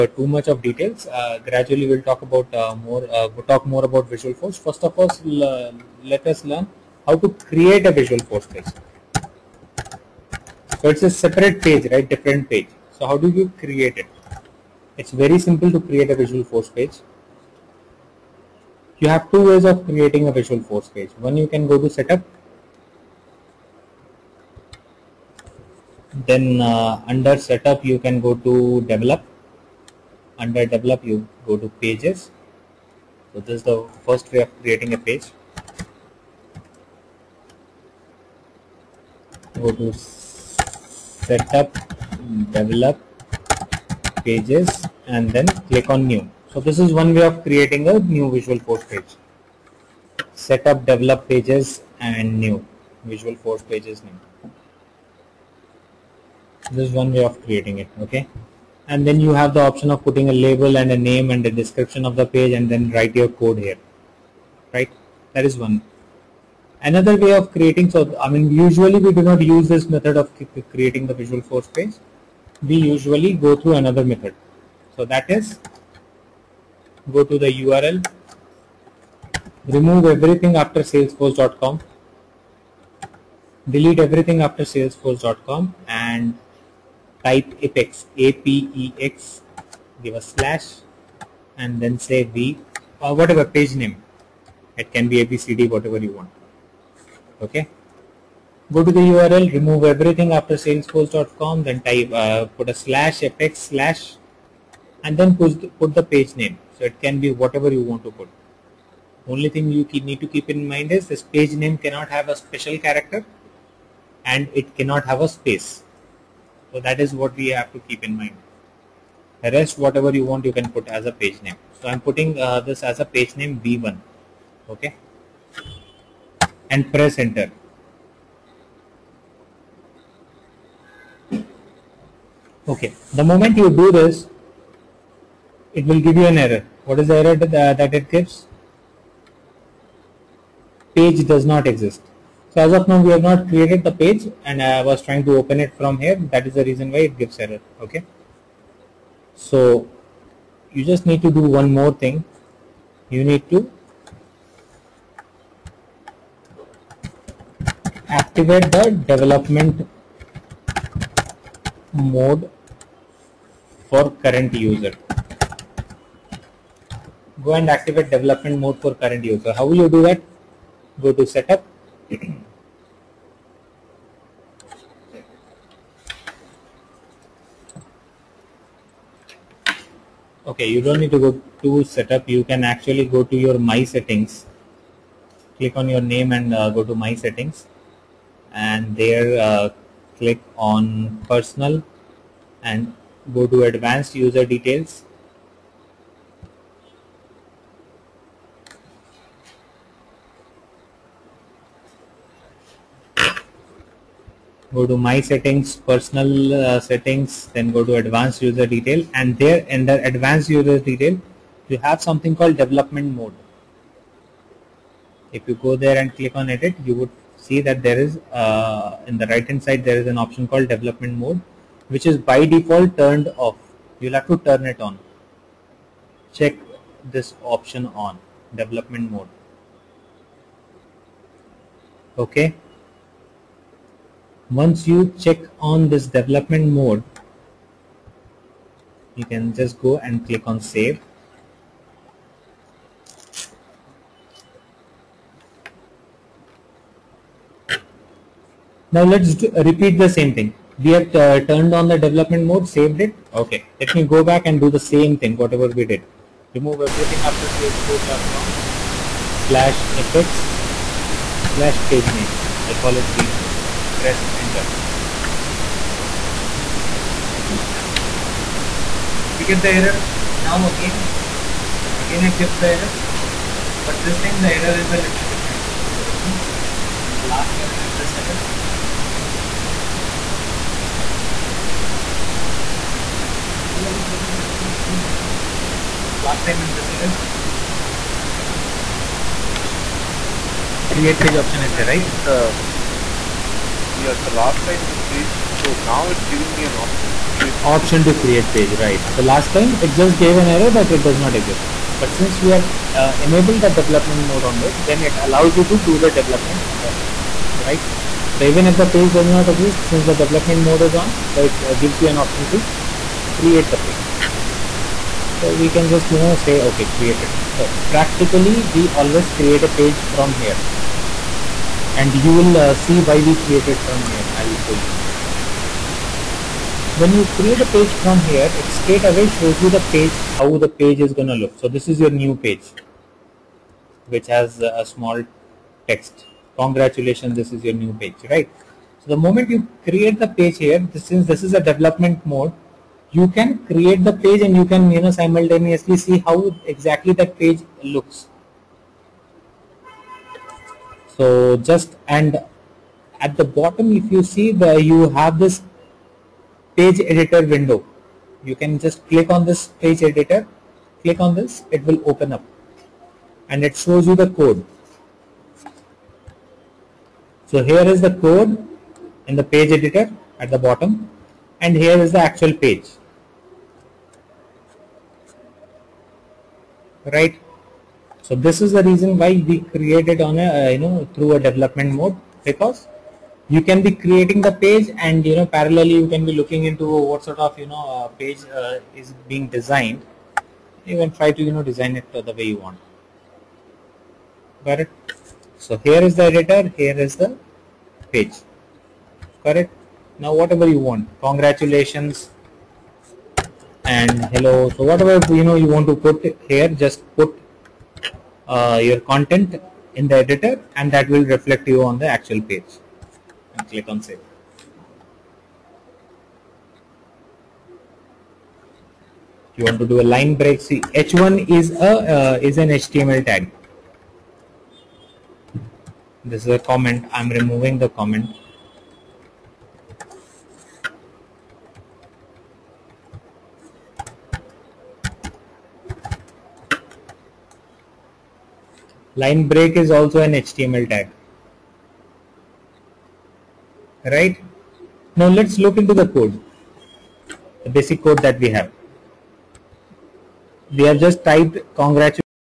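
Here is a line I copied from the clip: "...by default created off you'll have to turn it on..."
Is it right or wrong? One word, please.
wrong.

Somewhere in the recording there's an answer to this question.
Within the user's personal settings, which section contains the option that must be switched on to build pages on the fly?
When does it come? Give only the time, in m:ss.
3:13.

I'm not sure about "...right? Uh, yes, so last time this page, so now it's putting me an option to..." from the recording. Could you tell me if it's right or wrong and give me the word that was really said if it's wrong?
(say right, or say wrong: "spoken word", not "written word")
wrong: "giving", not "putting".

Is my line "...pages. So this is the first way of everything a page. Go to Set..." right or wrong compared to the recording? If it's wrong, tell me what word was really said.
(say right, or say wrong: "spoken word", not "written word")
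wrong: "creating", not "everything".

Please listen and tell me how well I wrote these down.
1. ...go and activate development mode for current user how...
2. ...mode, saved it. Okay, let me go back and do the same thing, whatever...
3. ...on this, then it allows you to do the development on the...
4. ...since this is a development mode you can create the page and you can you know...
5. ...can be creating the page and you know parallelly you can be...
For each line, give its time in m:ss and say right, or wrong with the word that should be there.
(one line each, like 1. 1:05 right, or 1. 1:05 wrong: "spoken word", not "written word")
1. 2:47 right
2. 4:12 right
3. 5:04 right
4. 5:41 right
5. 6:23 right.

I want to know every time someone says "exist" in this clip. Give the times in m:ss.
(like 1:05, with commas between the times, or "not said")
2:21, 5:01, 5:09.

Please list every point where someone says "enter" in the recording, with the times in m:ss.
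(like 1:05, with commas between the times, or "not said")
2:07, 4:24.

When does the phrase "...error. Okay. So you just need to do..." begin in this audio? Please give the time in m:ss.
2:27.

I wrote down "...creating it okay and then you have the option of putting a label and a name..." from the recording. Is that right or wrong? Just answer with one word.
right.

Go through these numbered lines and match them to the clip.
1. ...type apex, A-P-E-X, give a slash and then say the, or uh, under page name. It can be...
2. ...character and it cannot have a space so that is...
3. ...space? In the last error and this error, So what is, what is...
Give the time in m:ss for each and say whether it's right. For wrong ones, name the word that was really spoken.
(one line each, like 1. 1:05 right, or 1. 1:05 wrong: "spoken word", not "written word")
1. 1:27 wrong: "whatever", not "under"
2. 1:52 right
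3. 4:36 wrong: "difference", not "space".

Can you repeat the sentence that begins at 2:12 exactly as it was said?
Okay, the moment you do this, it will give you an error.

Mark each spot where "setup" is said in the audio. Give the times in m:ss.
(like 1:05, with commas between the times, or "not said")
0:21, 0:27, 2:51, 3:01.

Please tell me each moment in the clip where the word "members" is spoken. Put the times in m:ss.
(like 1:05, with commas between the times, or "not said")
not said.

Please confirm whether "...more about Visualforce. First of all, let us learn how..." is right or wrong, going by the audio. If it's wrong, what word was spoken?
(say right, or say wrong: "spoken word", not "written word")
right.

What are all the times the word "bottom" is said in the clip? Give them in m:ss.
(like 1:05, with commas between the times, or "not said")
5:53, 6:10.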